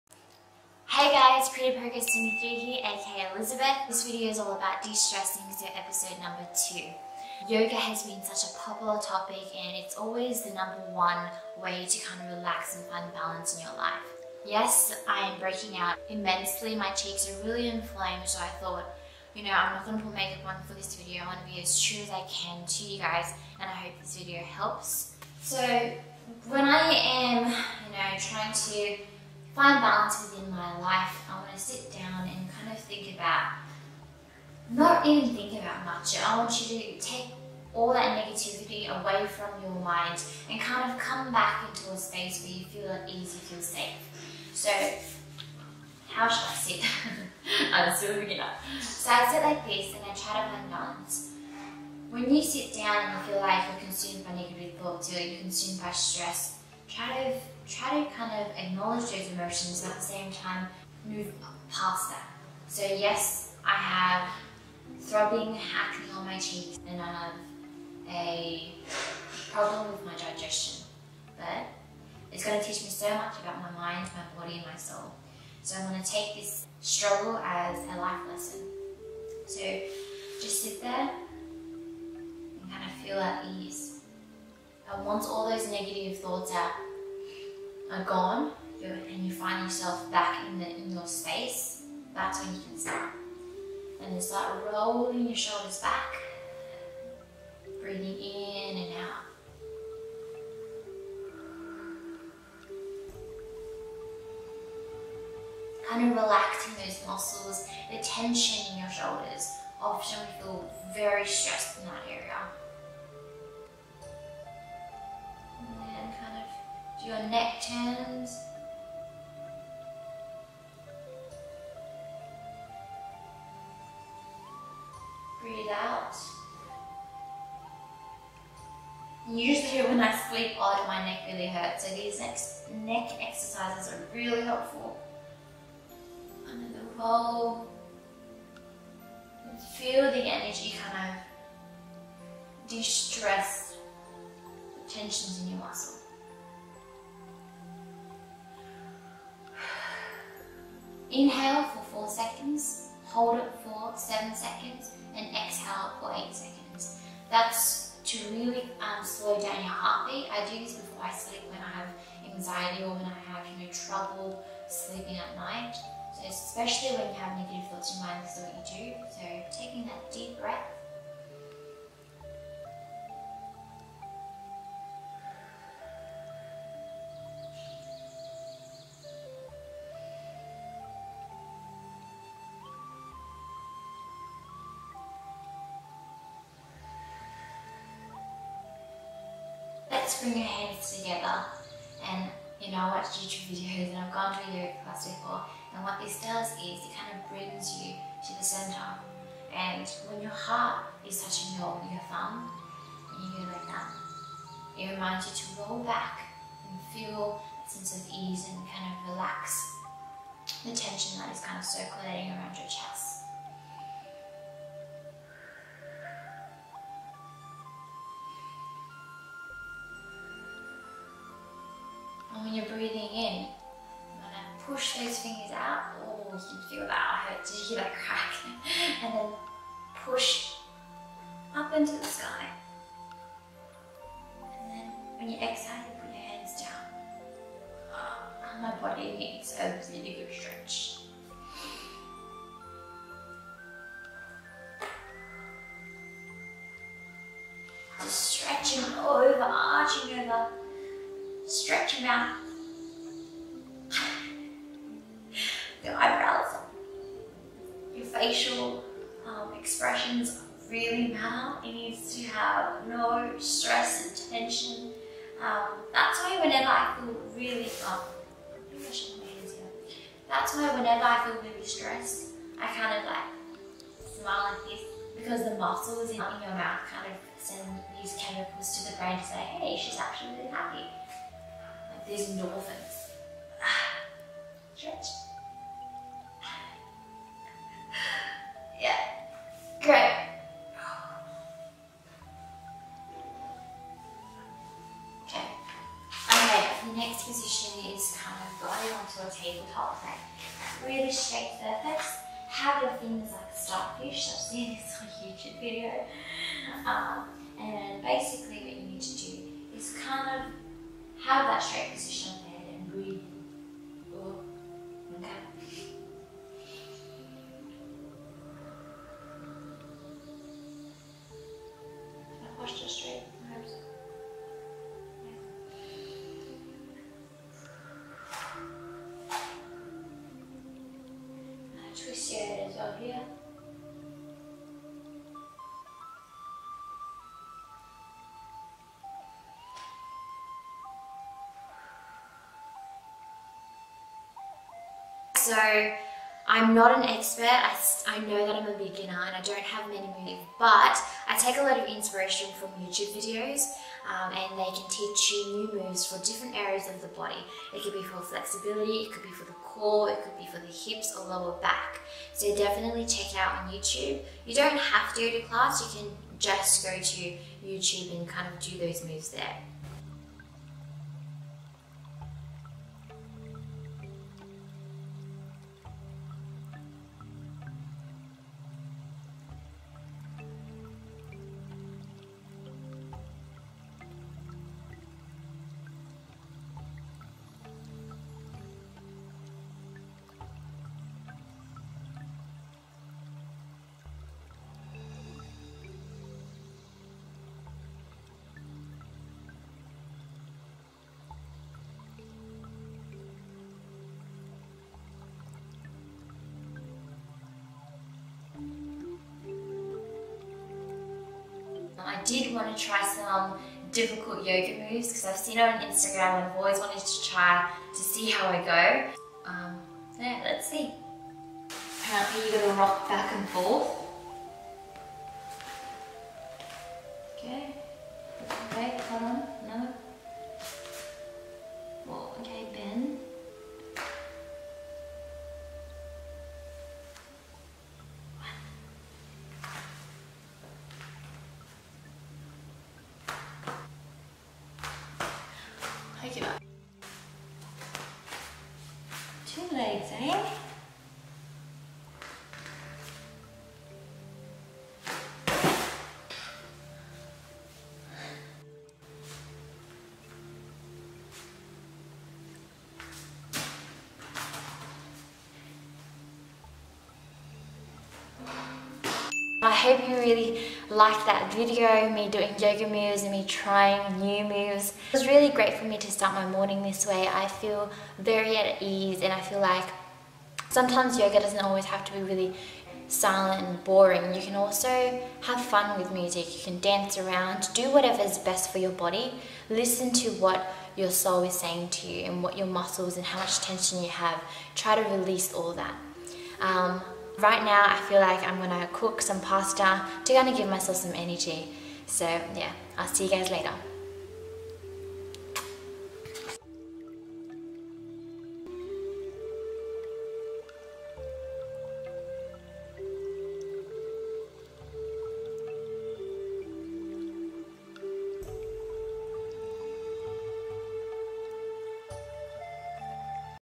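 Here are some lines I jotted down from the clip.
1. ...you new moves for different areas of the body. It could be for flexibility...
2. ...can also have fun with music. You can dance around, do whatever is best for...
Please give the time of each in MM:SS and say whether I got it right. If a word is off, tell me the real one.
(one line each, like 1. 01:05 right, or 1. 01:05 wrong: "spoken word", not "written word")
1. 05:55 right
2. 08:04 right.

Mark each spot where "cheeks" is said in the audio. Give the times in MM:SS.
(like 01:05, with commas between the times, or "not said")
00:16, 01:06.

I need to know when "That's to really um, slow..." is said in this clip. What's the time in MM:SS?
02:37.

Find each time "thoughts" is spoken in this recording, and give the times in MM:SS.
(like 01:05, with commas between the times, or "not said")
00:18, 00:54, 01:26, 02:47.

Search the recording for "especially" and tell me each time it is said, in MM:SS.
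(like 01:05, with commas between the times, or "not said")
02:46.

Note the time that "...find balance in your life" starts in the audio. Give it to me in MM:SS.
00:12.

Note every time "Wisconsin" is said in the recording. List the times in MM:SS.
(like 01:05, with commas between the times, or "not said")
not said.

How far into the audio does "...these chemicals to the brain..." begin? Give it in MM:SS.
04:38.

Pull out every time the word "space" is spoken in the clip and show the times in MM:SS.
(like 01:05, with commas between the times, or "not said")
00:41, 01:31.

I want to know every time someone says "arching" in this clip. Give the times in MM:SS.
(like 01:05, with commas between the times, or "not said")
04:09.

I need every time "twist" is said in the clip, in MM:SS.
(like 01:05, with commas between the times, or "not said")
05:32.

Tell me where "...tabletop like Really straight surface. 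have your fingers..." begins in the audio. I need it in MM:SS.
04:59.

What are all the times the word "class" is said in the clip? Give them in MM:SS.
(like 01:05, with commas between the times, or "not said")
03:14, 06:05.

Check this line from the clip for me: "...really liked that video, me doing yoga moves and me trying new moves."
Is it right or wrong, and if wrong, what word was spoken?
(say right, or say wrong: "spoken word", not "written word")
right.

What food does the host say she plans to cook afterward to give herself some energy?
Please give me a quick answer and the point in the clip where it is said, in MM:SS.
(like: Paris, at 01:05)
pasta, at 08:19.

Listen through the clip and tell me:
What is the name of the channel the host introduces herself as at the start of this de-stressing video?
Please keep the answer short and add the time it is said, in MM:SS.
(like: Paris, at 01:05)
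Pretty Progress 23, at 00:01.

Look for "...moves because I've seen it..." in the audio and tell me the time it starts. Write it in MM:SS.
06:54.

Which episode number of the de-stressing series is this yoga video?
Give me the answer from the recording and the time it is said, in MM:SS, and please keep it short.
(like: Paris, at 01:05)
2, at 00:05.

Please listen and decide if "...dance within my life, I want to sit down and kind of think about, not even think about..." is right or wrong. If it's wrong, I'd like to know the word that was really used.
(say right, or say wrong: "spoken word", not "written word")
wrong: "balance", not "dance".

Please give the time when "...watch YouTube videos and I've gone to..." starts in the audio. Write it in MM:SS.
03:12.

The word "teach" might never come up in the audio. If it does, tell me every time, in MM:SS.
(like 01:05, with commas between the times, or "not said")
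01:12, 05:54.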